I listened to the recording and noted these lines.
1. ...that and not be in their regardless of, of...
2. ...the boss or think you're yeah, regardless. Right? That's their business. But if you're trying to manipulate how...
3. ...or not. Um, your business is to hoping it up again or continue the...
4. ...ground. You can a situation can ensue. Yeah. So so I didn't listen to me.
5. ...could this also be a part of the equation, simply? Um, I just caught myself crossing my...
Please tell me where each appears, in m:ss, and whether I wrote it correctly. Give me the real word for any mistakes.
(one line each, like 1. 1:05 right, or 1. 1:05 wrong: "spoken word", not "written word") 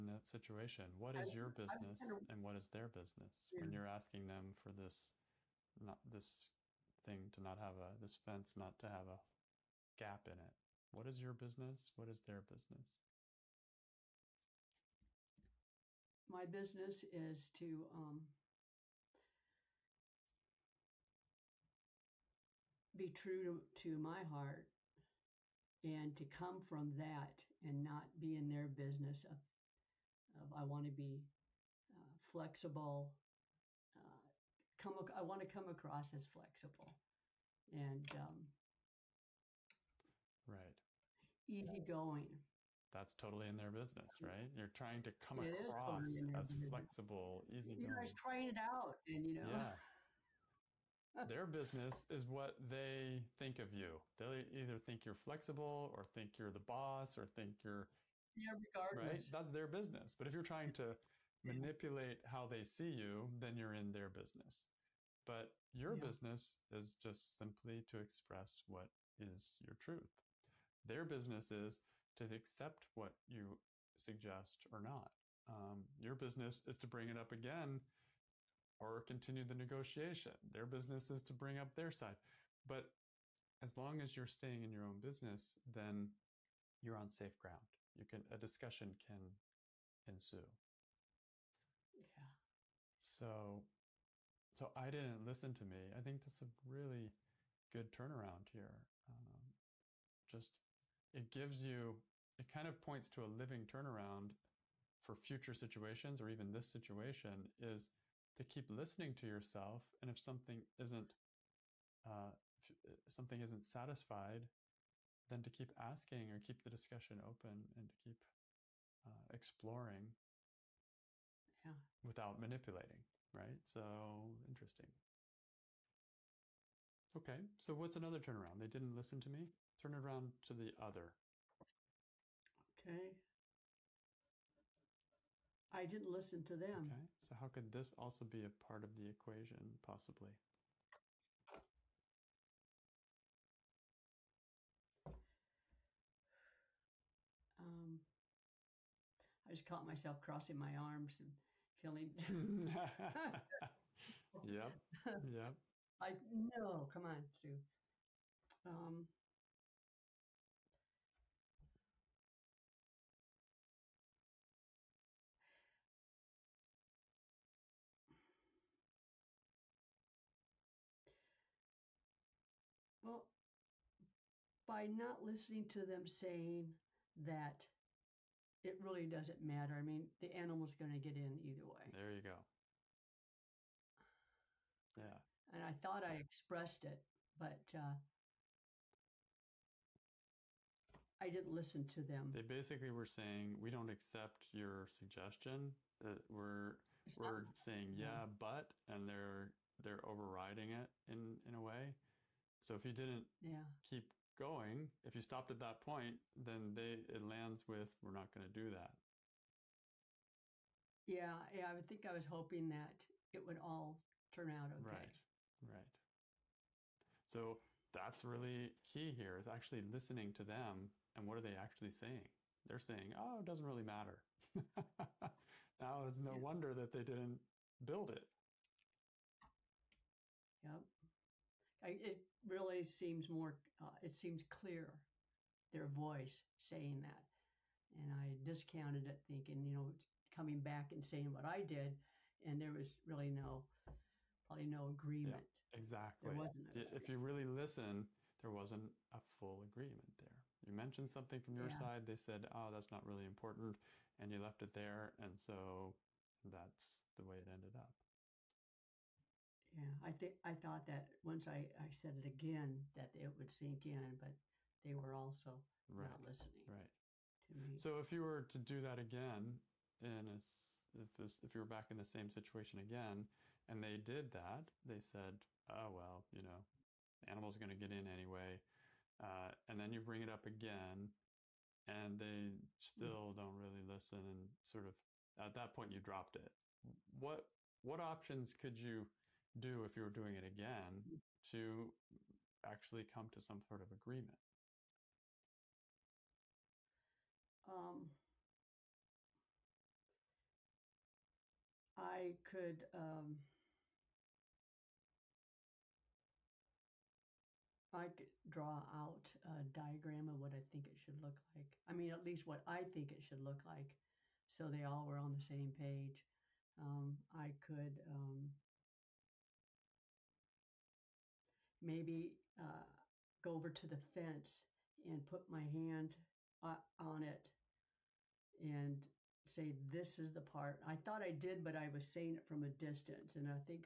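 1. 0:26 wrong: "business", not "regardless"
2. 0:56 right
3. 1:14 wrong: "bring", not "hoping"
4. 1:27 wrong: "discussion", not "situation"
5. 2:17 wrong: "possibly", not "simply".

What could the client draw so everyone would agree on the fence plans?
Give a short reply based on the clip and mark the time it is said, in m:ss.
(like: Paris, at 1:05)
a diagram, at 5:09.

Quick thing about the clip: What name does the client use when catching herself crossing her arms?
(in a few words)
Sue.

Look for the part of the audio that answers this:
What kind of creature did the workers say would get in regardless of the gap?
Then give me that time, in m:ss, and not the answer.
3:00.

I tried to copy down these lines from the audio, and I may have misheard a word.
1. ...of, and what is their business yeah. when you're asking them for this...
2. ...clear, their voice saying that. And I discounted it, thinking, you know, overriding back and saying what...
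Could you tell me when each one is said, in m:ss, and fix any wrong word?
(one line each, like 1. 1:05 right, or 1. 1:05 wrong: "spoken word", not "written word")
1. 0:02 right
2. 3:54 wrong: "coming", not "overriding".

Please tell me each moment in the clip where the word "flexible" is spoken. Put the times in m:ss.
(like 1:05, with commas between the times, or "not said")
0:32, 0:36, 0:46, 0:55.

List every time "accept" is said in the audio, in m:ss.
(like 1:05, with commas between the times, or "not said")
1:12, 3:13.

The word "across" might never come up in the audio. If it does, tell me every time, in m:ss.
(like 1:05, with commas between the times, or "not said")
0:35, 0:45.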